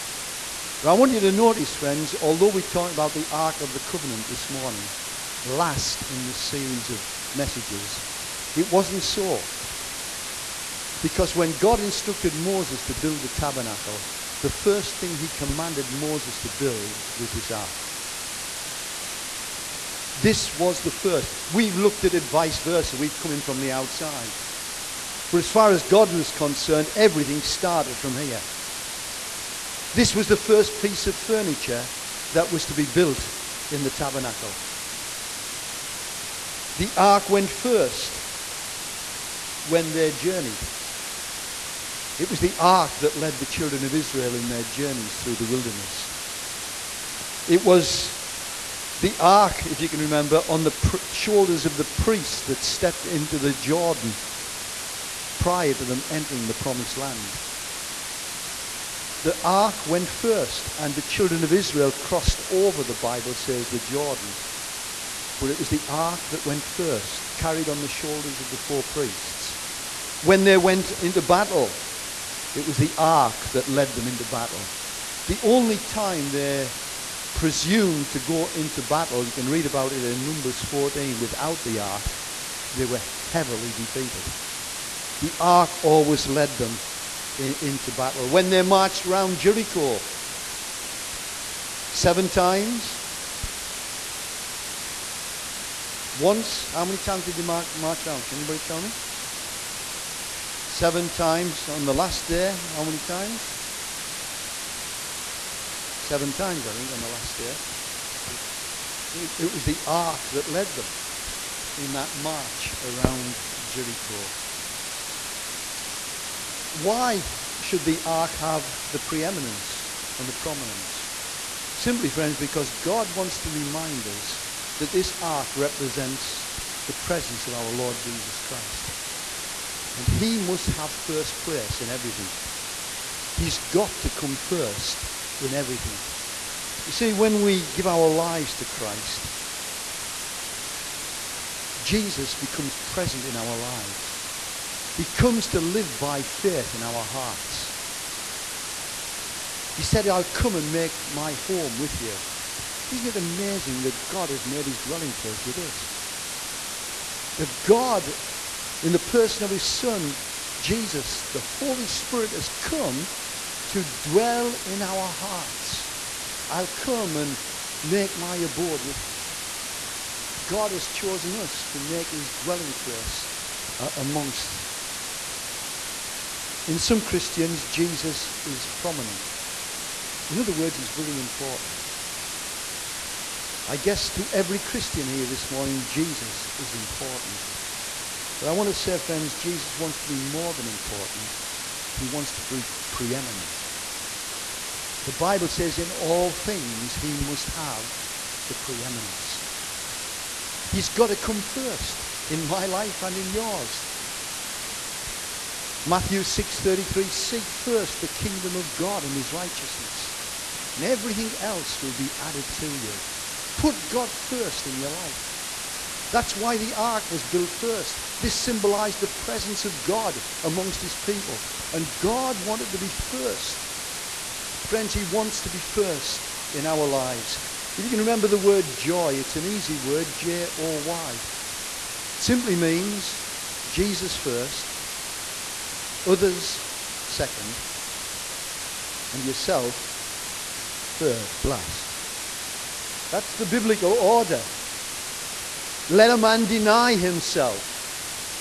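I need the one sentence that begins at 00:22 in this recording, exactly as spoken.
We've come in from the outside.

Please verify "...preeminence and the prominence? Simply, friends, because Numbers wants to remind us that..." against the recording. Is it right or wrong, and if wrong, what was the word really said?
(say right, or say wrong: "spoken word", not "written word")
wrong: "God", not "Numbers".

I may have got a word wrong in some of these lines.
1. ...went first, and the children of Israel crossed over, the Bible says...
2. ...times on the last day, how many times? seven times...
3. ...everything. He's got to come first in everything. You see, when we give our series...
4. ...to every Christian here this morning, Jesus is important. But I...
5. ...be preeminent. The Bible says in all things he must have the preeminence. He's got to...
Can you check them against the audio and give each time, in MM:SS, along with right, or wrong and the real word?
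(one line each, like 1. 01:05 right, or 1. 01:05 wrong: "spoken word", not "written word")
1. 00:59 right
2. 01:41 right
3. 02:11 wrong: "lives", not "series"
4. 03:04 right
5. 03:12 right.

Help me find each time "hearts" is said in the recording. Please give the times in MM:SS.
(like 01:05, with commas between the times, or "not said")
02:27, 02:45.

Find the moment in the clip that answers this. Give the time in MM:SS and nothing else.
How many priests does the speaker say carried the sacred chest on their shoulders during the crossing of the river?
01:08.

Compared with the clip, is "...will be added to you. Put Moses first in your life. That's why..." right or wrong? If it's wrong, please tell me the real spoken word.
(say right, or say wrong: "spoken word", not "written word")
wrong: "God", not "Moses".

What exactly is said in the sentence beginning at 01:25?
The ark always led them in, into battle.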